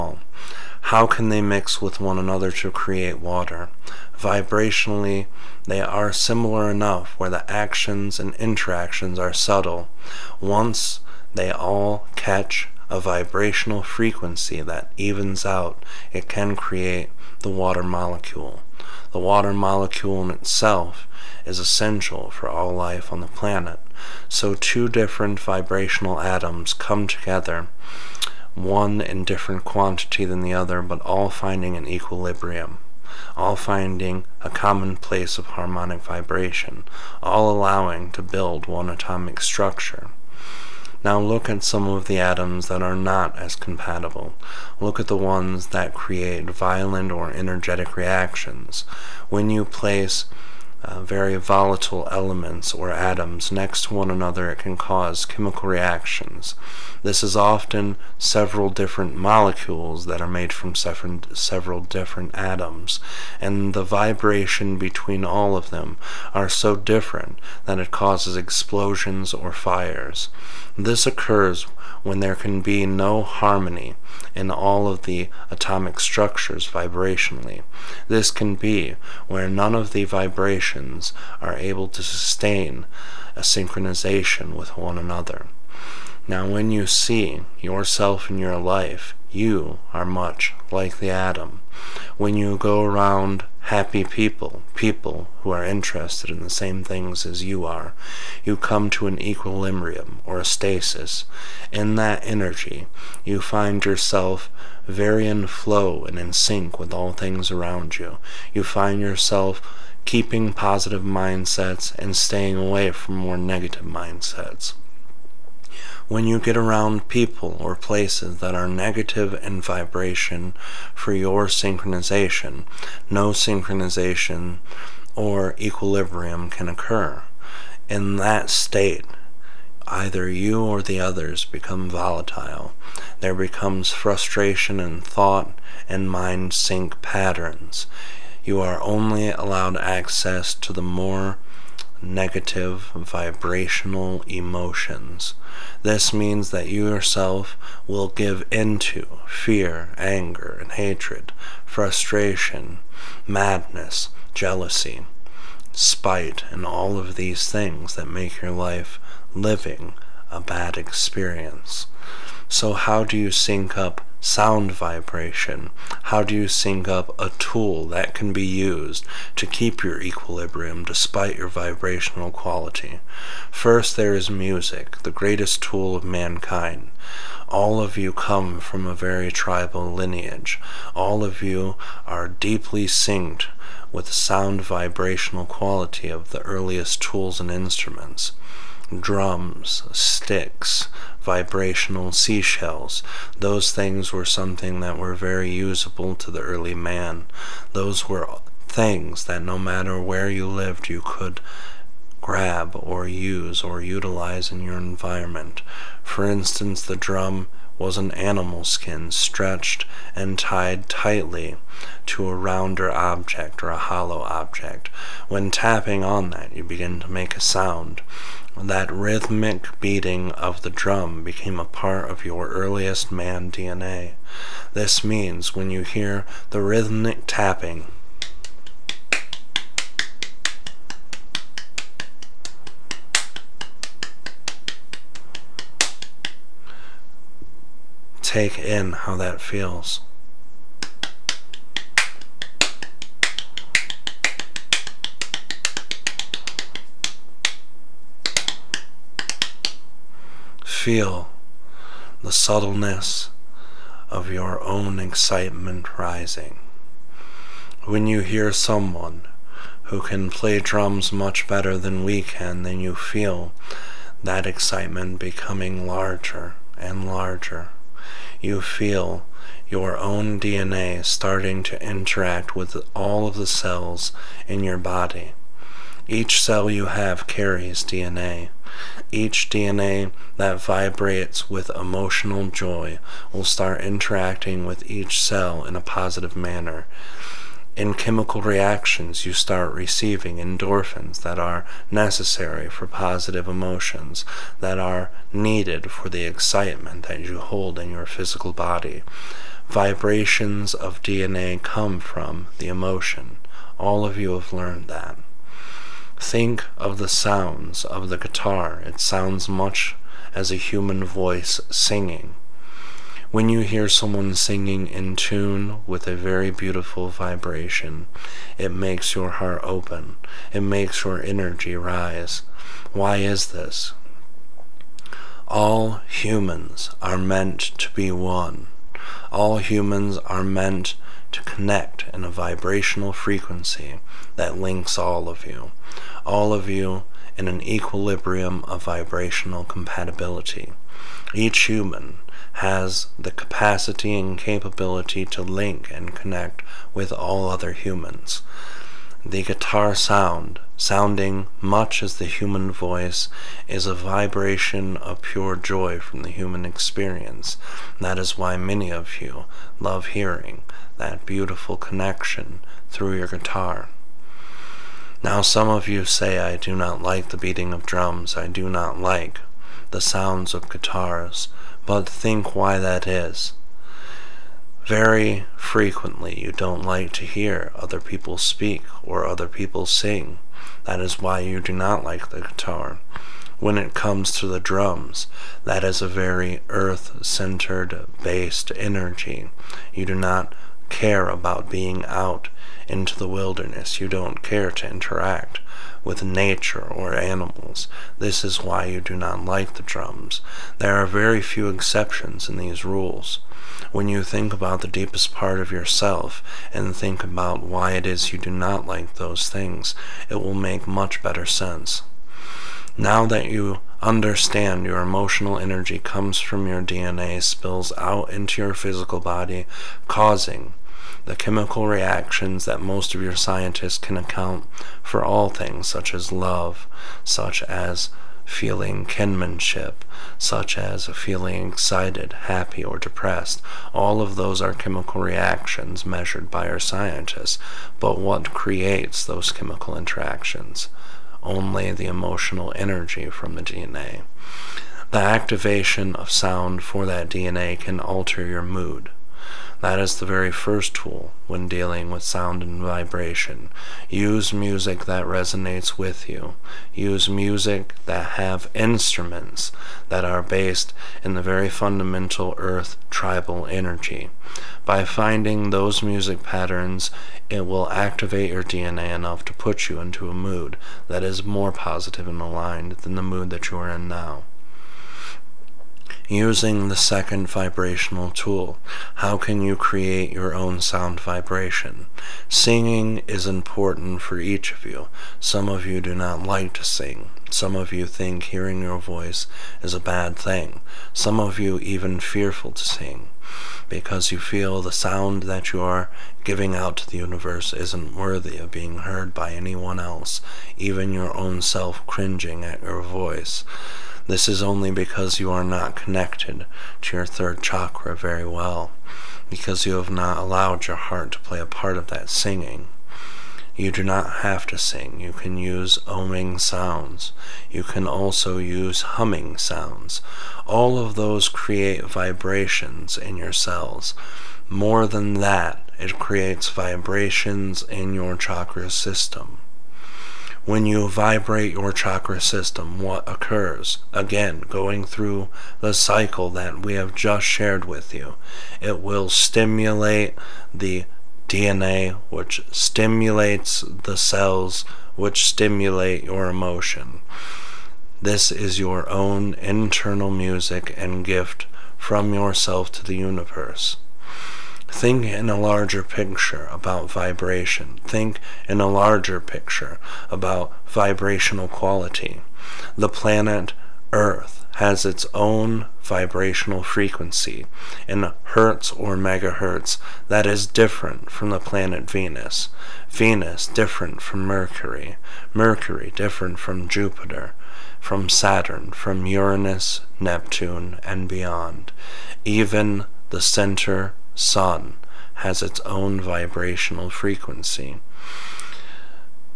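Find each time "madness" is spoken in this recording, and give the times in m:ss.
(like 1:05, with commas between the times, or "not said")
2:33.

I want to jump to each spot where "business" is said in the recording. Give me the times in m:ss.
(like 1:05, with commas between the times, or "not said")
not said.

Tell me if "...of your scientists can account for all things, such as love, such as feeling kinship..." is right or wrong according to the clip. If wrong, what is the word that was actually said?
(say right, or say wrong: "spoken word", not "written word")
right.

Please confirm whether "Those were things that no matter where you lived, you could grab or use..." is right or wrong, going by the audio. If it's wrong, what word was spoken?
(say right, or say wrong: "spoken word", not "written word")
right.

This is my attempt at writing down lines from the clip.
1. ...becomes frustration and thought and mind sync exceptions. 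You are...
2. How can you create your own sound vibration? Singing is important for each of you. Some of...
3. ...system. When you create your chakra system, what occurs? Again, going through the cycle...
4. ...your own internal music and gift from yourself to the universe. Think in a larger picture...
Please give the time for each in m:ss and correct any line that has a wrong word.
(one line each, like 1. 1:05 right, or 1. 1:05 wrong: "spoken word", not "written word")
1. 2:13 wrong: "patterns", not "exceptions"
2. 7:59 right
3. 8:48 wrong: "vibrate", not "create"
4. 9:08 right.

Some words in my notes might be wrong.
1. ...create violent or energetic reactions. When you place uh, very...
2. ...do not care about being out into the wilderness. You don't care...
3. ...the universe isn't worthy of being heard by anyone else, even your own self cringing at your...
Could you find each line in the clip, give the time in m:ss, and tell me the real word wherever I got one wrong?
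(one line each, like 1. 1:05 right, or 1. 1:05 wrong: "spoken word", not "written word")
1. 0:45 right
2. 6:30 right
3. 8:17 right.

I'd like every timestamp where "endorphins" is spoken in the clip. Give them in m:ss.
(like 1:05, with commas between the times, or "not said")
4:50.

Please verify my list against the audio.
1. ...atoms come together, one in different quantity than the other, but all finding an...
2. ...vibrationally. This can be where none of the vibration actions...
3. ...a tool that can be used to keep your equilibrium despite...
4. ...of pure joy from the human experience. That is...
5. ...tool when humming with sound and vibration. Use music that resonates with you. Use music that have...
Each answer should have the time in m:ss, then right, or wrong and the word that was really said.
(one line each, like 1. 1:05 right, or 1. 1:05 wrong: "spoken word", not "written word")
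1. 0:26 right
2. 1:16 wrong: "emotions", not "actions"
3. 2:47 right
4. 5:54 right
5. 7:30 wrong: "dealing", not "humming".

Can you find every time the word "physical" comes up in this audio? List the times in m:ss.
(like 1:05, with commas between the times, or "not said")
4:58, 6:58.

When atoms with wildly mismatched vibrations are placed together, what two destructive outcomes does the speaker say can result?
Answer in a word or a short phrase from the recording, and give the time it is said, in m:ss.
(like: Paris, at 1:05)
explosions or fires, at 1:08.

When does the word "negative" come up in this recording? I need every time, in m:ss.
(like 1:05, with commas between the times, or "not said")
1:53, 1:58, 2:22.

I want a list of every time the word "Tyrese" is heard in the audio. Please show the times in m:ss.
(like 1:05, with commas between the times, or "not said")
not said.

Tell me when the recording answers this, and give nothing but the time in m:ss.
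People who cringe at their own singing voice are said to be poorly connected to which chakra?
8:27.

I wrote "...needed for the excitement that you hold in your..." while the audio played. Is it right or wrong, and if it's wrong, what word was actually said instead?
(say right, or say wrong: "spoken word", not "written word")
right.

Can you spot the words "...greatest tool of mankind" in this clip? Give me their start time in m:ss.
2:55.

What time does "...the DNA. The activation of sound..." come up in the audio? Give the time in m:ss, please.
7:23.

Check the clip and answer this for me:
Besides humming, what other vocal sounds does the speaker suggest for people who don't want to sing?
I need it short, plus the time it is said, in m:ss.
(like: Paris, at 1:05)
oming sounds, at 8:36.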